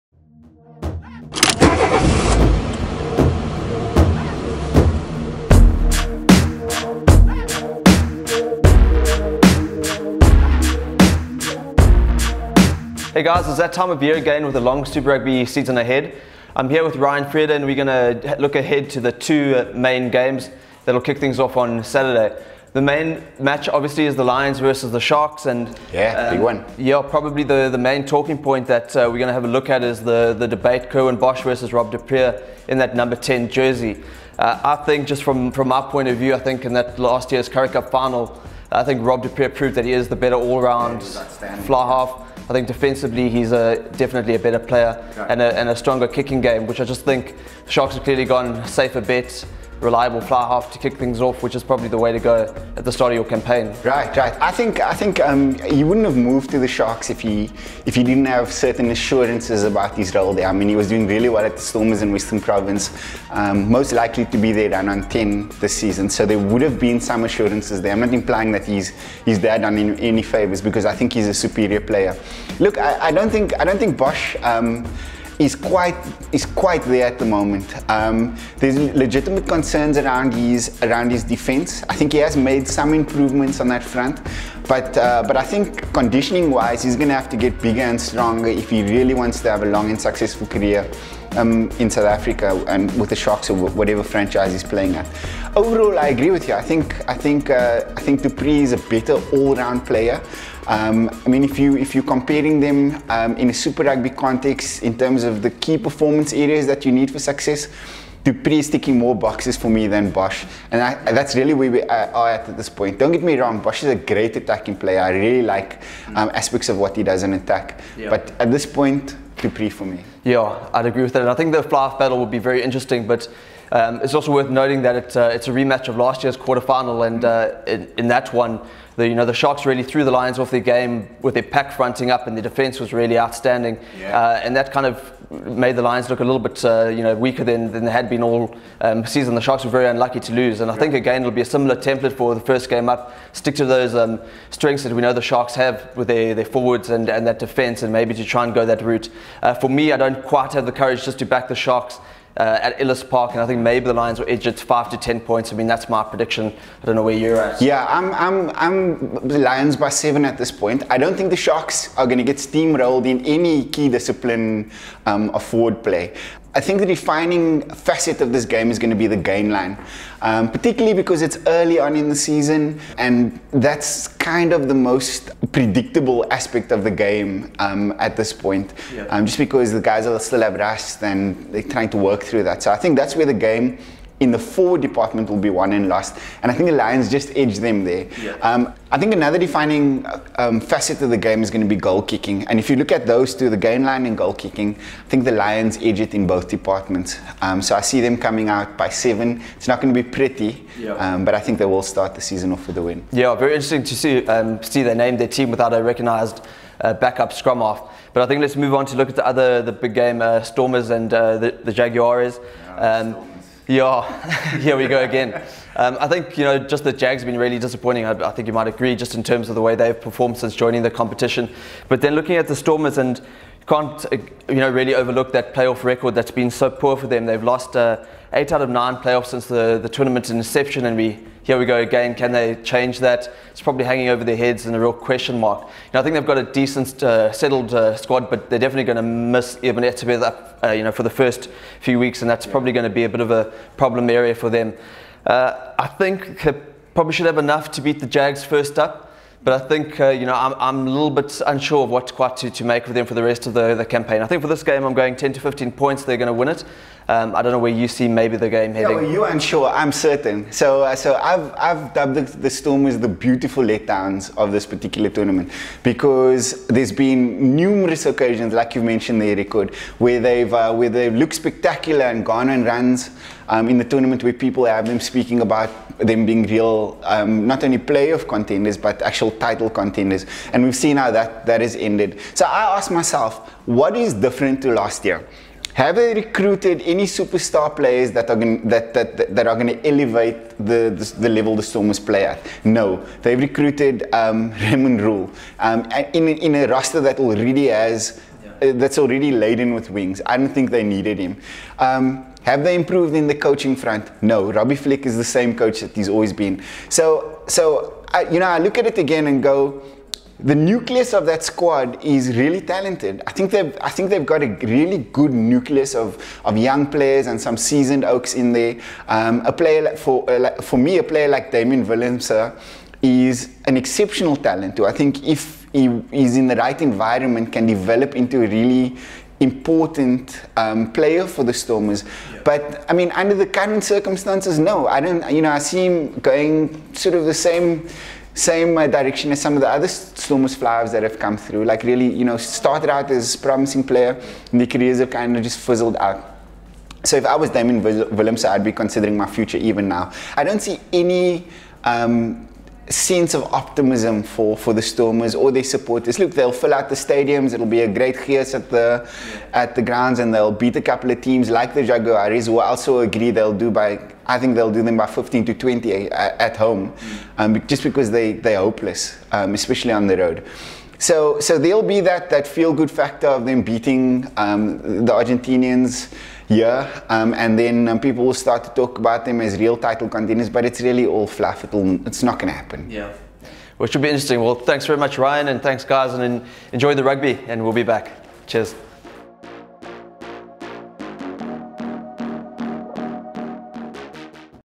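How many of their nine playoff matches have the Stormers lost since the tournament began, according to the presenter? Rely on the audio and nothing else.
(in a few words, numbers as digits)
8.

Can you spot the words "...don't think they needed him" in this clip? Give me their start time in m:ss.
5:00.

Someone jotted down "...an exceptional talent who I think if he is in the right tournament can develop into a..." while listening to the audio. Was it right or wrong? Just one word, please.
wrong.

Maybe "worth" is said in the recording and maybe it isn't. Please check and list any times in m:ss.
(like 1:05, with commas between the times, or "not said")
2:04.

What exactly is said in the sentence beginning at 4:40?
And we've seen how that, that has ended.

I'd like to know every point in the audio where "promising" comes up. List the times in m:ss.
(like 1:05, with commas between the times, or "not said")
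5:43.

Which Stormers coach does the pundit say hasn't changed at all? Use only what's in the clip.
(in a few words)
Robbie Fleck.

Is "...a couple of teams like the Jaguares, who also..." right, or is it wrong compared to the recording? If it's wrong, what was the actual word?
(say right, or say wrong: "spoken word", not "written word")
right.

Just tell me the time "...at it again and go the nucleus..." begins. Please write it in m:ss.
5:08.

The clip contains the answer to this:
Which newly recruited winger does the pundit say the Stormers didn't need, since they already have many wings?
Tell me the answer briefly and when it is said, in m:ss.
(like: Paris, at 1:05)
Raymond Rhule, at 4:54.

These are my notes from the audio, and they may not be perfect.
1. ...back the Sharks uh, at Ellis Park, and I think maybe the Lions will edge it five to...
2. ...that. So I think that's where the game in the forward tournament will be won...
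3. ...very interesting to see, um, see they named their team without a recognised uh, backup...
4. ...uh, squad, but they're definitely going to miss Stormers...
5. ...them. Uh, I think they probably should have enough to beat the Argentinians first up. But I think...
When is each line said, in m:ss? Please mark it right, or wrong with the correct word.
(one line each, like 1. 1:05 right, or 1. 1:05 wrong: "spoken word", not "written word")
1. 2:31 right
2. 3:02 wrong: "department", not "tournament"
3. 3:23 right
4. 3:57 wrong: "Ibn", not "Stormers"
5. 4:04 wrong: "Jags", not "Argentinians".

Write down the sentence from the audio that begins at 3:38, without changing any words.
I, I, think you might agree just in terms of the way they've performed since joining the competition.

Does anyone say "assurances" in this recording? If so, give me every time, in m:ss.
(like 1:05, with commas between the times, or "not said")
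0:58, 1:07.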